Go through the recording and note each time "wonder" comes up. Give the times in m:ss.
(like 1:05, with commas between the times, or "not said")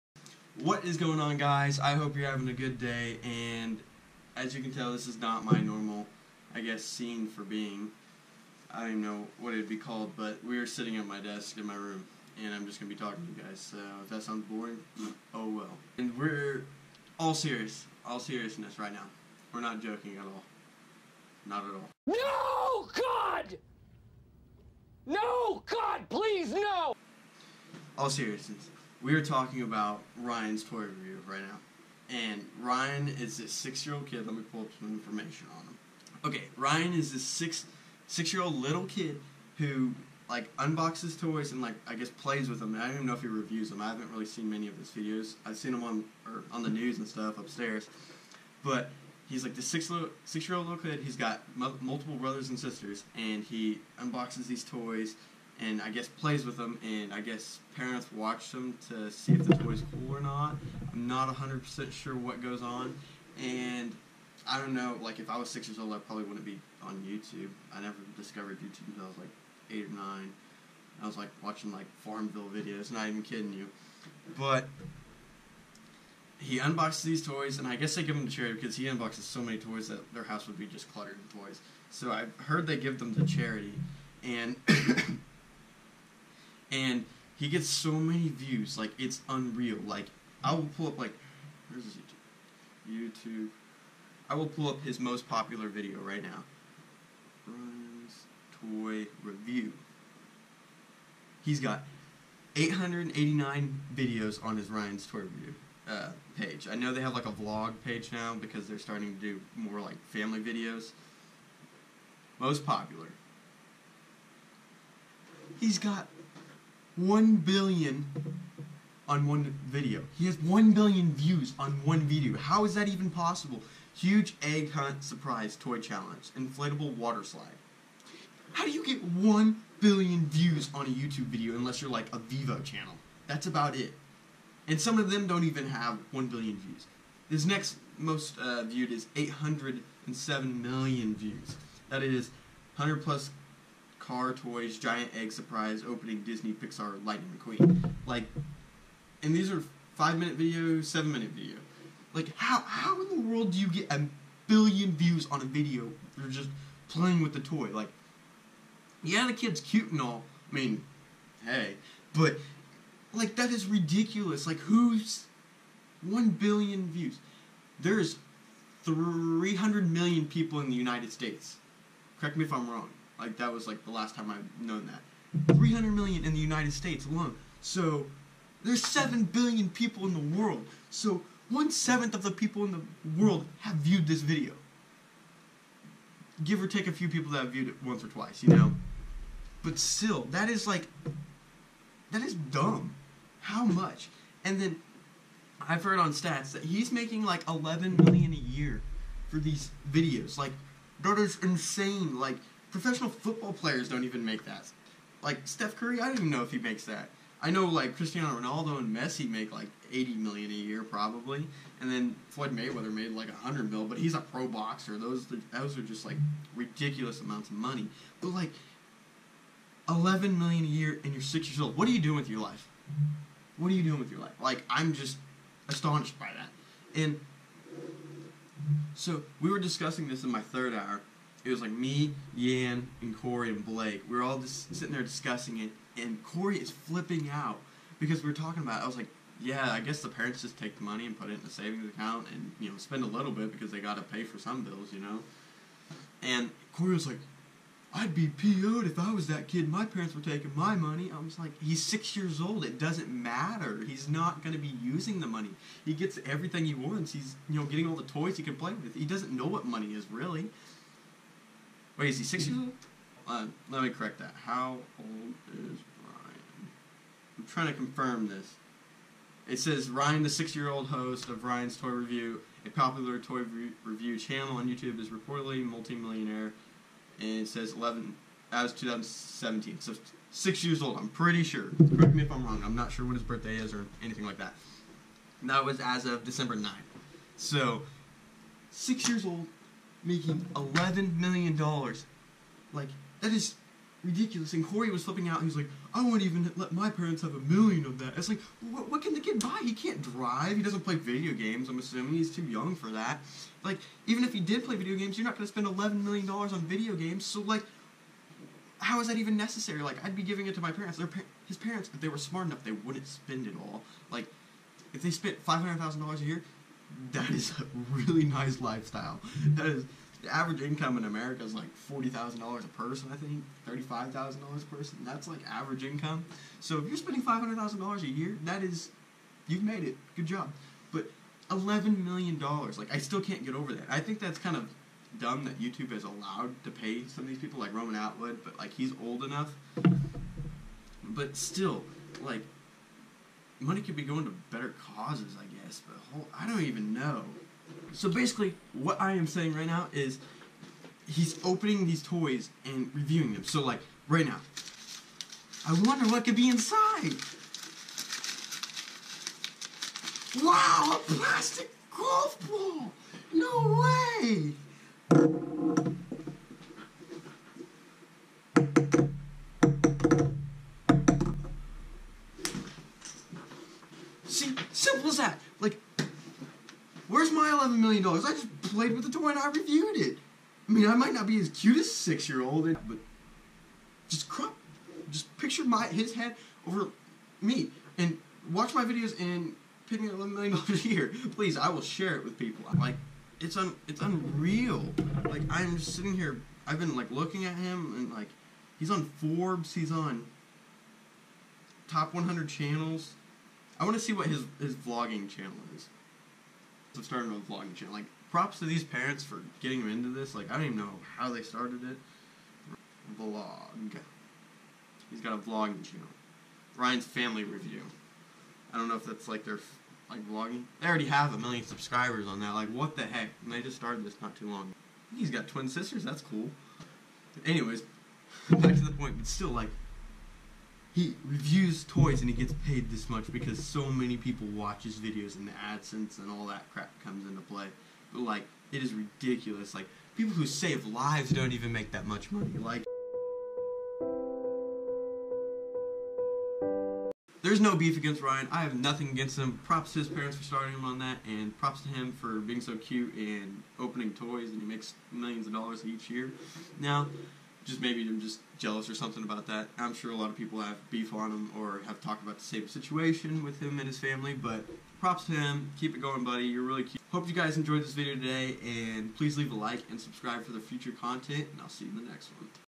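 5:55.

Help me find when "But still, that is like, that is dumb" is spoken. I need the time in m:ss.
3:09.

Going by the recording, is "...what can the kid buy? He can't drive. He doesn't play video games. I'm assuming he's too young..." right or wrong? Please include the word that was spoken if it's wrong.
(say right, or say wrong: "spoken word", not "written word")
right.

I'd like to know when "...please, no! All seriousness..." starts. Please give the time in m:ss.
0:26.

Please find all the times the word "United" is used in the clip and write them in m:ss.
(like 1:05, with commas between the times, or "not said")
2:50, 2:56.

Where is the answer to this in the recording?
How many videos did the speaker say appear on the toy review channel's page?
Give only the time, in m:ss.
1:42.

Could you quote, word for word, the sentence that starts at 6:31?
I will share it with people.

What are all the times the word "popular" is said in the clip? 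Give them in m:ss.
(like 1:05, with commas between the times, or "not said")
1:35, 1:52, 4:32.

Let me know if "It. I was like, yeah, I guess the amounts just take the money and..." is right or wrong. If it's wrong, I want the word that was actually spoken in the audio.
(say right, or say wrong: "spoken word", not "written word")
wrong: "parents", not "amounts".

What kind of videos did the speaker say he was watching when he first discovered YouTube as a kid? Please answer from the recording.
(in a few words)
Farmville videos.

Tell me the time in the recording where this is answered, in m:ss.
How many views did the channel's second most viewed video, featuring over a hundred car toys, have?
2:19.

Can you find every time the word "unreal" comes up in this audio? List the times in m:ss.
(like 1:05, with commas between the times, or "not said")
1:29, 6:34.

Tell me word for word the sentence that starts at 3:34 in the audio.
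Those those are just like ridiculous amounts of money.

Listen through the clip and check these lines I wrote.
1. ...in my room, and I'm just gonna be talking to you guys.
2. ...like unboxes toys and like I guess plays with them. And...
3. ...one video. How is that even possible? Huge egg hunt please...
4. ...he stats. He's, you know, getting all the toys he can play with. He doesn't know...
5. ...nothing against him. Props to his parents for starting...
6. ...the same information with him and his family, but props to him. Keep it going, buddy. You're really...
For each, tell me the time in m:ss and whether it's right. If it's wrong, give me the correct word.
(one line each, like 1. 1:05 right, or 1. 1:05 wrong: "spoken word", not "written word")
1. 0:11 right
2. 0:40 right
3. 2:01 wrong: "surprise", not "please"
4. 4:16 wrong: "wants", not "stats"
5. 7:28 right
6. 7:42 wrong: "situation", not "information".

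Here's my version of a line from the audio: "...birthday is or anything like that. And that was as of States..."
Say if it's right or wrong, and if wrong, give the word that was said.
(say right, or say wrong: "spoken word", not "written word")
wrong: "December", not "States".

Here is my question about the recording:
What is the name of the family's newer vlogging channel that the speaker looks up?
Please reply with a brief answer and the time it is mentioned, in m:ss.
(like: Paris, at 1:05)
Ryan's Family Review, at 6:56.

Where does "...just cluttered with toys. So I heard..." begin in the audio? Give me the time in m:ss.
1:20.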